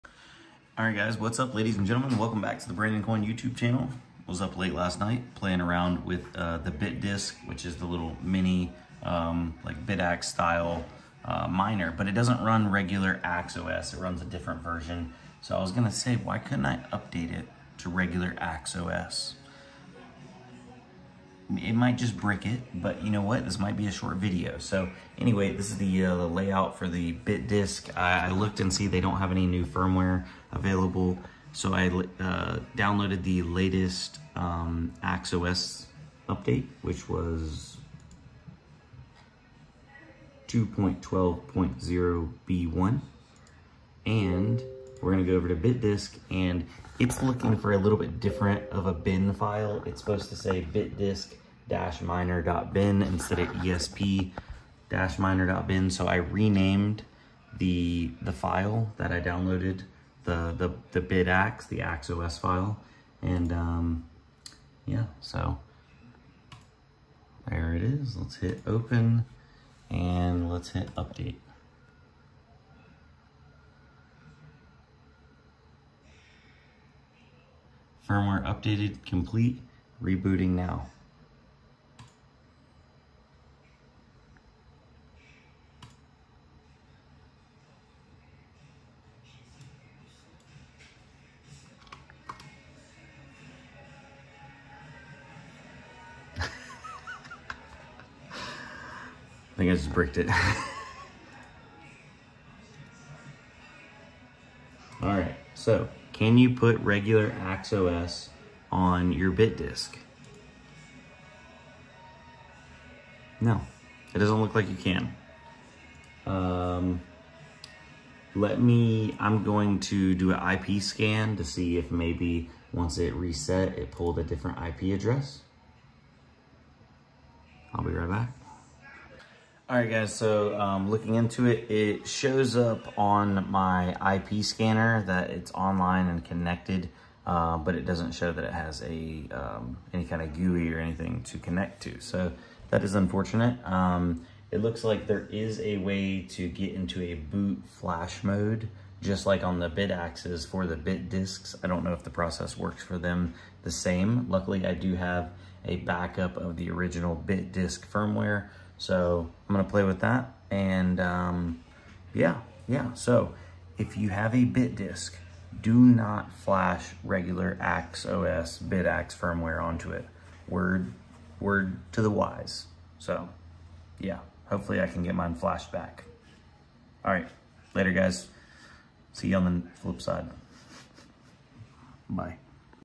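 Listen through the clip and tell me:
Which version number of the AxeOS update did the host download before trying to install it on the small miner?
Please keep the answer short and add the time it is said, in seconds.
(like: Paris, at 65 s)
2.12.0 B1, at 40 s.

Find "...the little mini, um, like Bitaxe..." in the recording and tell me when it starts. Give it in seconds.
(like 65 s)
7 s.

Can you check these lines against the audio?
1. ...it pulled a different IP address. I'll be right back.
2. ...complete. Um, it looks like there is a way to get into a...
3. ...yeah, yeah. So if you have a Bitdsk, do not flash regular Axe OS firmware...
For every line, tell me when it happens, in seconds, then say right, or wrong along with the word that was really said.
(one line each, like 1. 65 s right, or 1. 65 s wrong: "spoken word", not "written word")
1. 123 s right
2. 142 s wrong: "unfortunate", not "complete"
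3. 162 s right.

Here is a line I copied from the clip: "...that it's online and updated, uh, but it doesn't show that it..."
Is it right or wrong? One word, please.
wrong.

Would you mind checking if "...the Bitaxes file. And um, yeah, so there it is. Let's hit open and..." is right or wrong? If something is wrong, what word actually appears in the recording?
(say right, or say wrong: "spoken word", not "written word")
wrong: "AxeOS", not "Bitaxes".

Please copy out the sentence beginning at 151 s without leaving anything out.
I don't know if the process works for them the same.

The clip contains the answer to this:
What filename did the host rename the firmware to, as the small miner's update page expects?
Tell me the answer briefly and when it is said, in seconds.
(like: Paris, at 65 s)
bitdisk-miner.bin, at 50 s.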